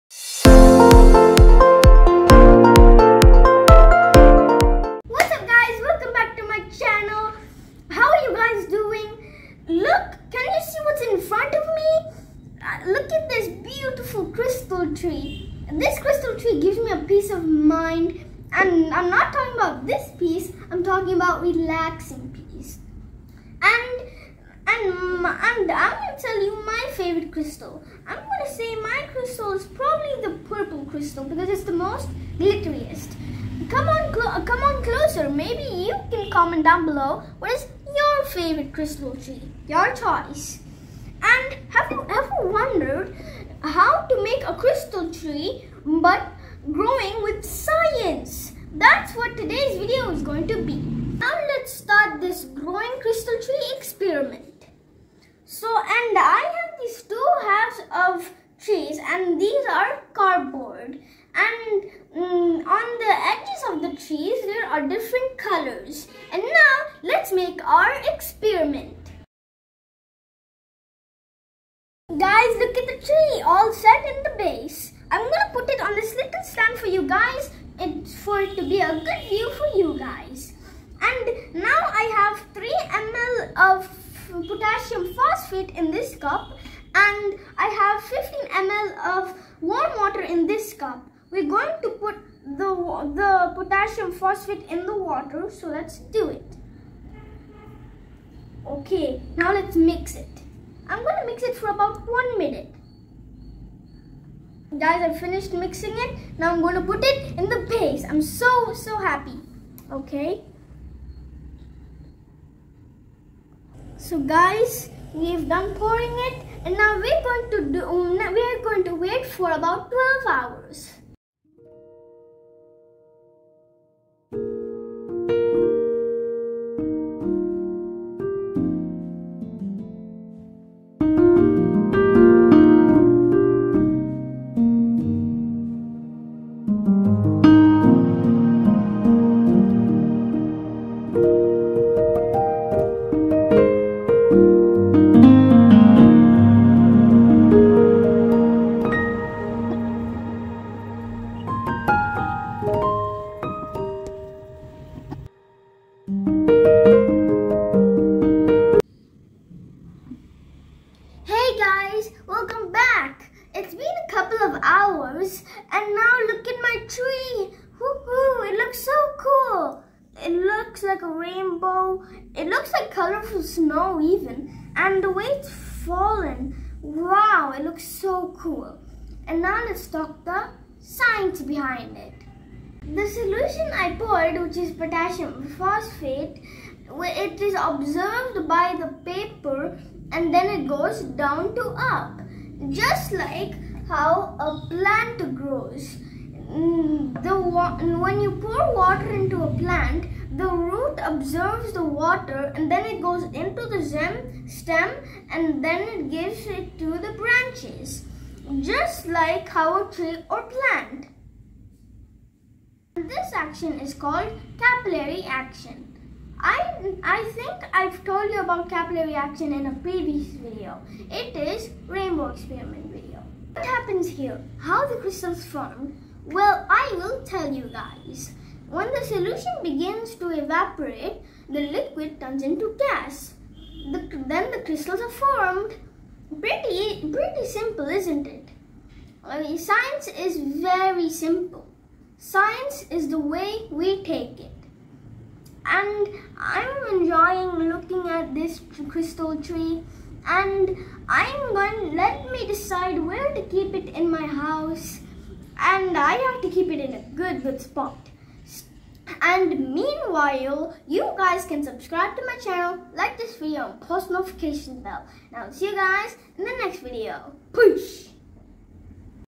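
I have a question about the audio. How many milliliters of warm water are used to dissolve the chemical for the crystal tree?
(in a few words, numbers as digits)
15 ml.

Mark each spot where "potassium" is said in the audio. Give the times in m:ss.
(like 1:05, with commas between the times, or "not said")
1:24, 1:33, 3:04.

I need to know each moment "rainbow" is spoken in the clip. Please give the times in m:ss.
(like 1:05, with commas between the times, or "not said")
2:51, 3:41.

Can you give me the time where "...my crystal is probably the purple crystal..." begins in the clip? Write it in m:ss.
0:28.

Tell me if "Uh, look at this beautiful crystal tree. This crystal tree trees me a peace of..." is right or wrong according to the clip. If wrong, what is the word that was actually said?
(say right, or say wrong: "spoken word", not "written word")
wrong: "gives", not "trees".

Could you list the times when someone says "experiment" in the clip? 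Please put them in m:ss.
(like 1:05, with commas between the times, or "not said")
0:53, 1:08, 3:42.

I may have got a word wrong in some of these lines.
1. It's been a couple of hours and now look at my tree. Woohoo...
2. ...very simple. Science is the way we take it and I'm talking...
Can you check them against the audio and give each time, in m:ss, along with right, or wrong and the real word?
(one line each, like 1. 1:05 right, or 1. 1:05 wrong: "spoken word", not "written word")
1. 2:43 right
2. 4:00 wrong: "enjoying", not "talking".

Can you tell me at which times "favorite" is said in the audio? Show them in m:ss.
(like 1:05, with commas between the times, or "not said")
0:26, 0:38.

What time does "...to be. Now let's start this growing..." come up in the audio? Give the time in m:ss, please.
0:50.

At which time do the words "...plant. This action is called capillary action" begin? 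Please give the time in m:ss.
3:30.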